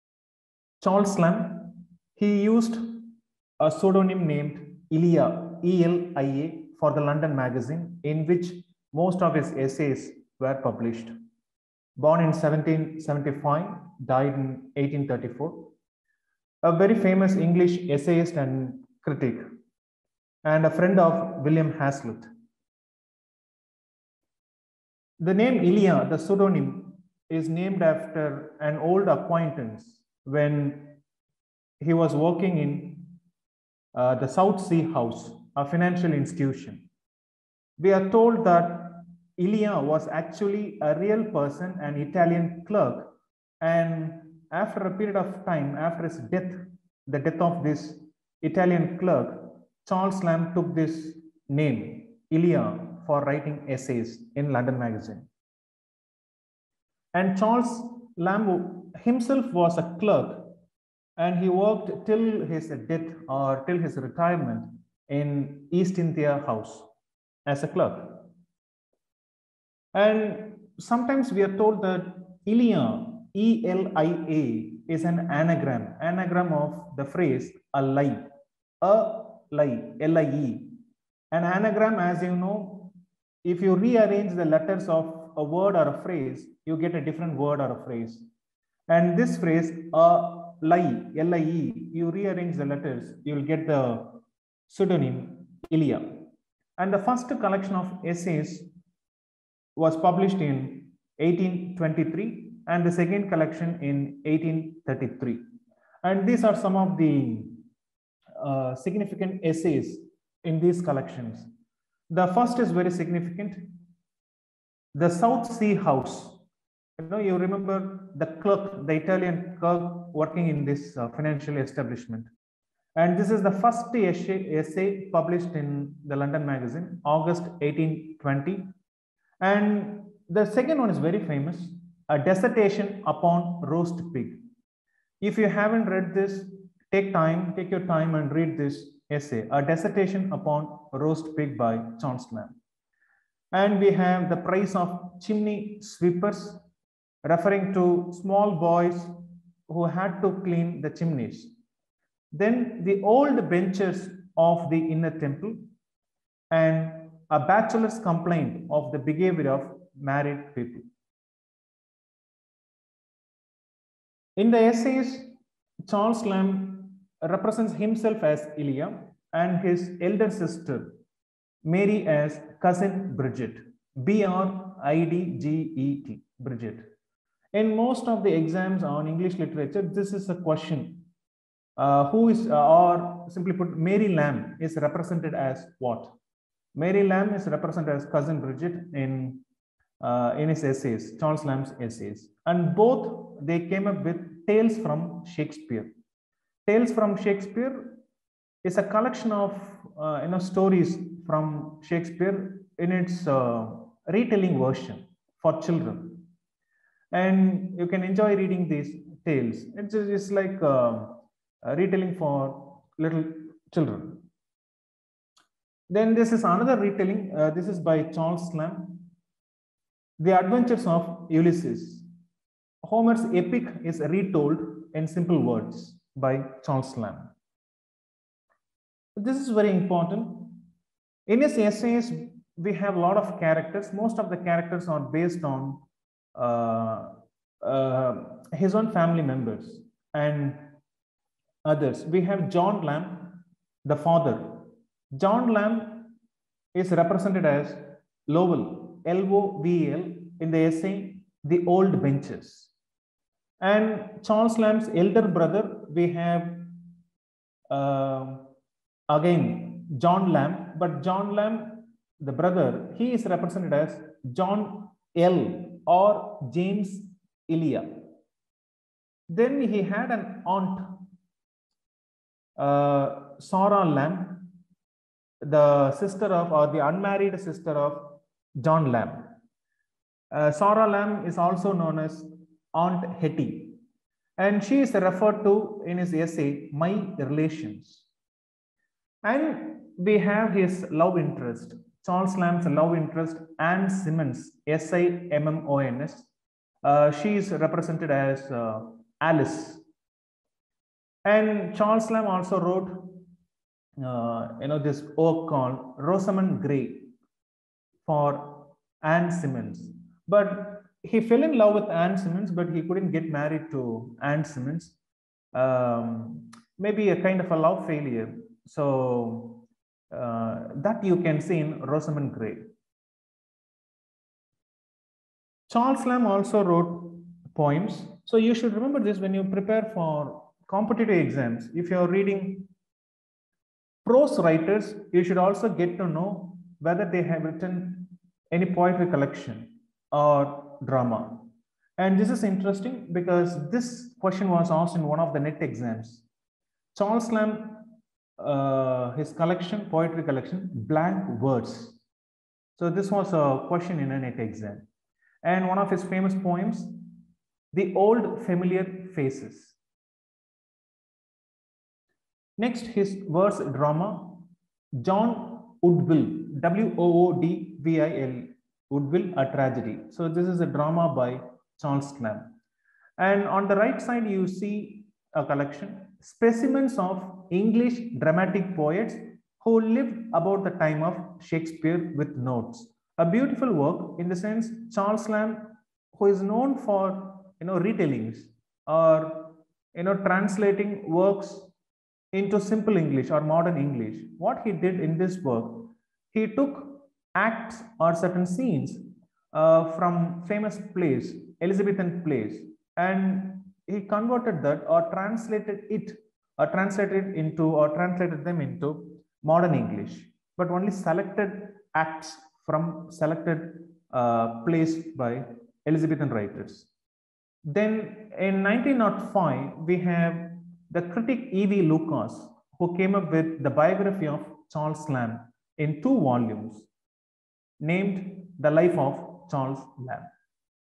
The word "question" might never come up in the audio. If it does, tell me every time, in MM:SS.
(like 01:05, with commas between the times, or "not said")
03:00, 05:44, 05:53.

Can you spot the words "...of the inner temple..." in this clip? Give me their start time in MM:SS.
02:34.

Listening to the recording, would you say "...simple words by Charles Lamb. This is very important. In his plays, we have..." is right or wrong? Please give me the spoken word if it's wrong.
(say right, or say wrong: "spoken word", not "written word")
wrong: "essays", not "plays".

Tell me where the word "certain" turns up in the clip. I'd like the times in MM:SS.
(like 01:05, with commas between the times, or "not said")
06:38.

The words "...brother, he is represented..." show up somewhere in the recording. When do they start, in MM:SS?
04:22.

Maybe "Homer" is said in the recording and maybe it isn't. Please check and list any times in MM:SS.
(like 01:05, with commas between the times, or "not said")
03:42.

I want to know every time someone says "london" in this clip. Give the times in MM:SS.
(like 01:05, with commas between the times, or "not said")
00:07, 00:54, 02:06.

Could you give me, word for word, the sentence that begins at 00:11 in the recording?
Born in 1775, died in 1834.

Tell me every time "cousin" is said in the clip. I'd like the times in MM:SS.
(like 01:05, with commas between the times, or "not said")
02:52, 03:08.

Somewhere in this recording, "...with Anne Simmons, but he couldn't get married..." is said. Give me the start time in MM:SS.
05:11.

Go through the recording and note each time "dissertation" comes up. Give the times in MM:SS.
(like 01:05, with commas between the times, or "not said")
02:12, 02:19.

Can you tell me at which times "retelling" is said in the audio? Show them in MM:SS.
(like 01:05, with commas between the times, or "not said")
03:24, 03:31, 03:36, 06:27.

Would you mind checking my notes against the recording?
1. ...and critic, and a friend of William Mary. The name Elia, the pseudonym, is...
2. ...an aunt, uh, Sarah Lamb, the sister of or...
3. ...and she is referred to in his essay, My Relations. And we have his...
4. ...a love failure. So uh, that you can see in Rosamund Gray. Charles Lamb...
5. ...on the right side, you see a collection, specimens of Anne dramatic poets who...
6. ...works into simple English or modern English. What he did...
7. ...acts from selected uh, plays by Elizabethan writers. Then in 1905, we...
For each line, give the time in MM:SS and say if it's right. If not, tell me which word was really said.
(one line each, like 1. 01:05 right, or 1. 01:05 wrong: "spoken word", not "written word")
1. 00:18 wrong: "Hazlitt", not "Mary"
2. 04:30 right
3. 04:44 right
4. 05:17 right
5. 06:13 wrong: "English", not "Anne"
6. 06:31 right
7. 06:51 right.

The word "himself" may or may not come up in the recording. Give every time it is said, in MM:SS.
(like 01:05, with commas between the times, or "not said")
00:59, 02:47.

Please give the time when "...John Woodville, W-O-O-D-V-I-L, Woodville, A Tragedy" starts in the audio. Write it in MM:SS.
06:05.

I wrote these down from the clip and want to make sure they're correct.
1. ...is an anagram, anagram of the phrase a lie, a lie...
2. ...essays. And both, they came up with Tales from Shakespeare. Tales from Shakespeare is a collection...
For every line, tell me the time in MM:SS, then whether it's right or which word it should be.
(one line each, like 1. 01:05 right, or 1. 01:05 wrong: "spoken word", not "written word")
1. 01:14 right
2. 03:11 right.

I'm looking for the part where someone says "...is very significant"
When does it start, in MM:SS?
01:52.